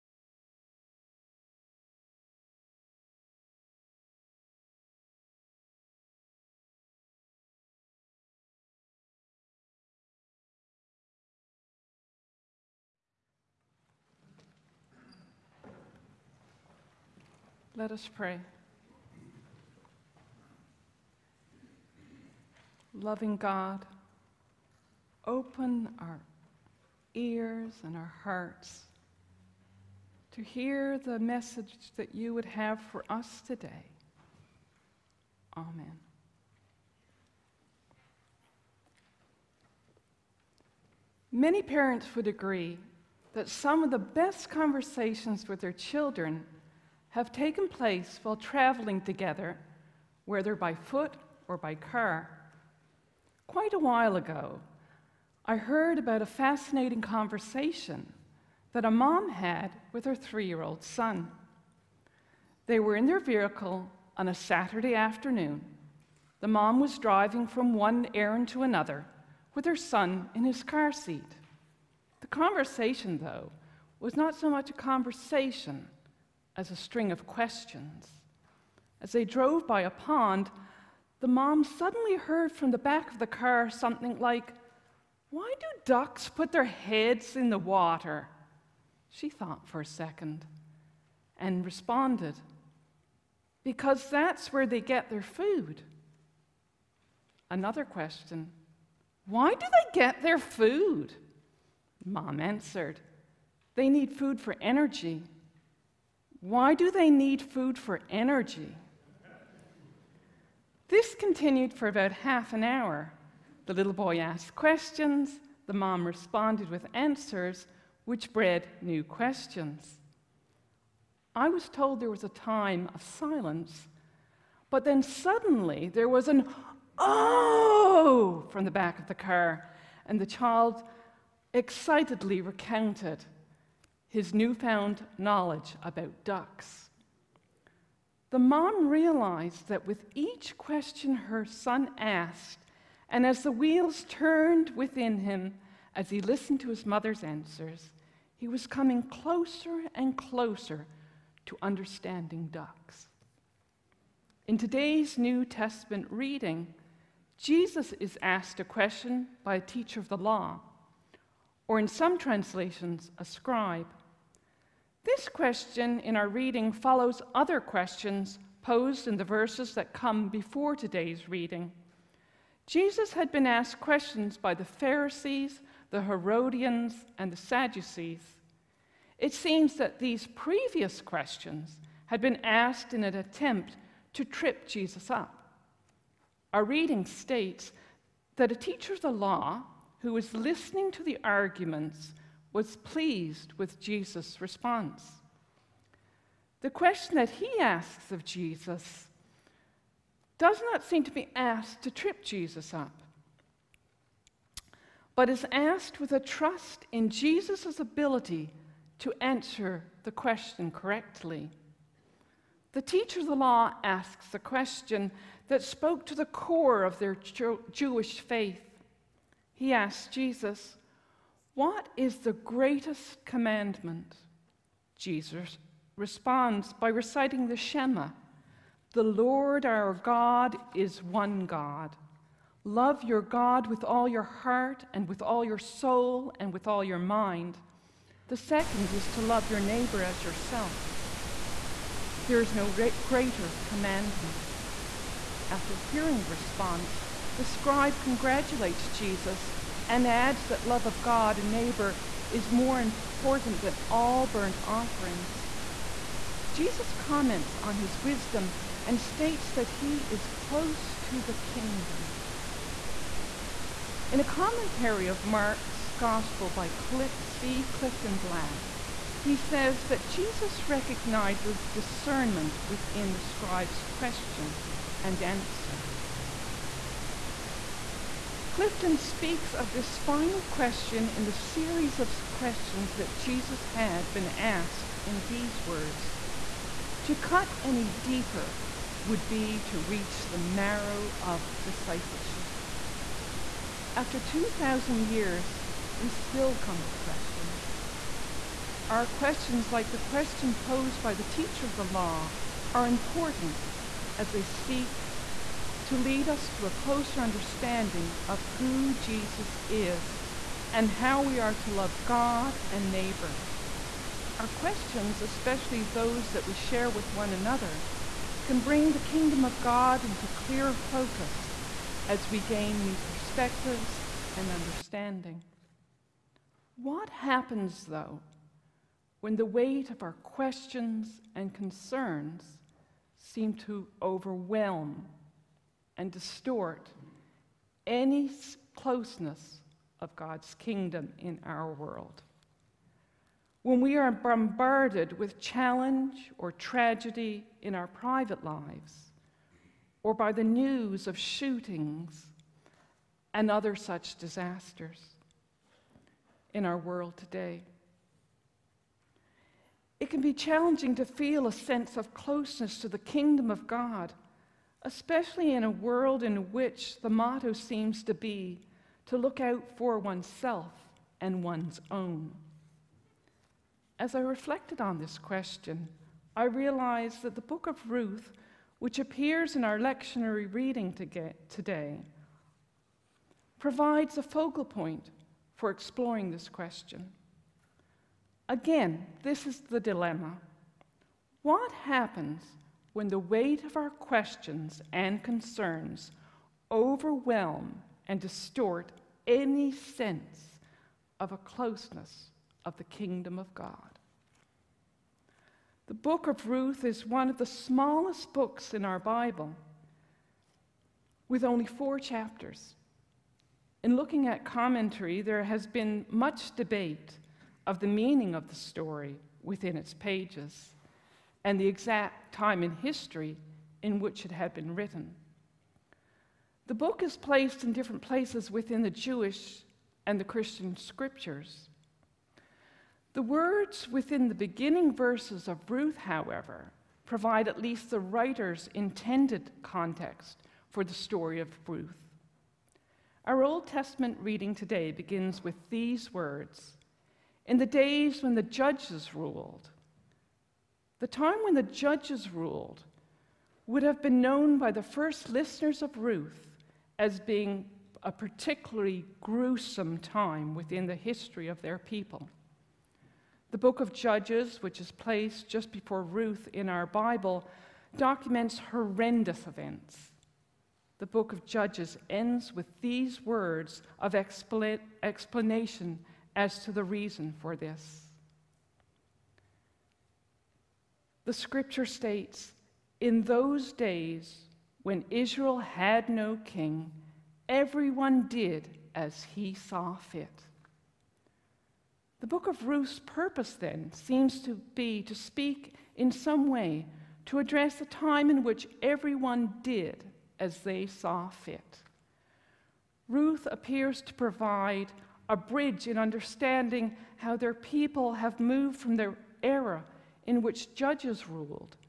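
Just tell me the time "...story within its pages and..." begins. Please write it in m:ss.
6:58.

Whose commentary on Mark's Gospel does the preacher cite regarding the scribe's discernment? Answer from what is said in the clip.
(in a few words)
C. Clifton Black.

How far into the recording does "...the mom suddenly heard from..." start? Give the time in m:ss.
1:21.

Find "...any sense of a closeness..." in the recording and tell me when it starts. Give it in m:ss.
6:39.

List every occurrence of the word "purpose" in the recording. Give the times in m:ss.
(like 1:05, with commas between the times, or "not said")
8:13.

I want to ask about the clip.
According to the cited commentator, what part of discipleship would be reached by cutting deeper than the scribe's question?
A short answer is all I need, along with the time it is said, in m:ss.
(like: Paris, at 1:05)
The marrow, at 4:50.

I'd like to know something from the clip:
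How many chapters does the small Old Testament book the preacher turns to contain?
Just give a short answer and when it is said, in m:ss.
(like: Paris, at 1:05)
4, at 6:51.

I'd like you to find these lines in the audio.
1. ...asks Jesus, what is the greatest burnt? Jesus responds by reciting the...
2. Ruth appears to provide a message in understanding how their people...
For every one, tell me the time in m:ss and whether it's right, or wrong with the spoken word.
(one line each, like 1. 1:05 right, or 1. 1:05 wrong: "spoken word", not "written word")
1. 3:39 wrong: "commandment", not "burnt"
2. 8:23 wrong: "bridge", not "message".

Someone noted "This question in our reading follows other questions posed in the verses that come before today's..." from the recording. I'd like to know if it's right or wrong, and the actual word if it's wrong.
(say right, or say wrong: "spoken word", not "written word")
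right.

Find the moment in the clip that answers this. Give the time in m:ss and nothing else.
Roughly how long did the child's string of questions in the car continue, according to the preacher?
1:51.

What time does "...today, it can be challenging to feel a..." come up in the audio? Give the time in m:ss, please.
5:57.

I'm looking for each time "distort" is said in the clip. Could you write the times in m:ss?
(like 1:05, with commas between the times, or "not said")
5:36, 6:38.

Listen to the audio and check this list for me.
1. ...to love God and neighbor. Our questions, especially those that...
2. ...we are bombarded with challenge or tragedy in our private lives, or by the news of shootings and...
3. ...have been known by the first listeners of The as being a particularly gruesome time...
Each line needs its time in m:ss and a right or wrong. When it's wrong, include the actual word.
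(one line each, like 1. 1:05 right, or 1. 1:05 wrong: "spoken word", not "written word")
1. 5:11 right
2. 5:43 right
3. 7:33 wrong: "Ruth", not "The".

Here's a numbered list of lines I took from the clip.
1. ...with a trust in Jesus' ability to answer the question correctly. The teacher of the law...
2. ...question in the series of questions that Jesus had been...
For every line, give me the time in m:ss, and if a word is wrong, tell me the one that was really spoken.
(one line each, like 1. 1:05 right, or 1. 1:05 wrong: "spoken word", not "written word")
1. 3:26 right
2. 4:40 right.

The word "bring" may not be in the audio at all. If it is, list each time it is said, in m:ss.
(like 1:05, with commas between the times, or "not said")
5:18.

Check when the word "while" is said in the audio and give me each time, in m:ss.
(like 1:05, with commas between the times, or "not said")
0:48, 0:53.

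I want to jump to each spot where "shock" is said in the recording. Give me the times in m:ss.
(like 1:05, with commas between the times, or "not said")
not said.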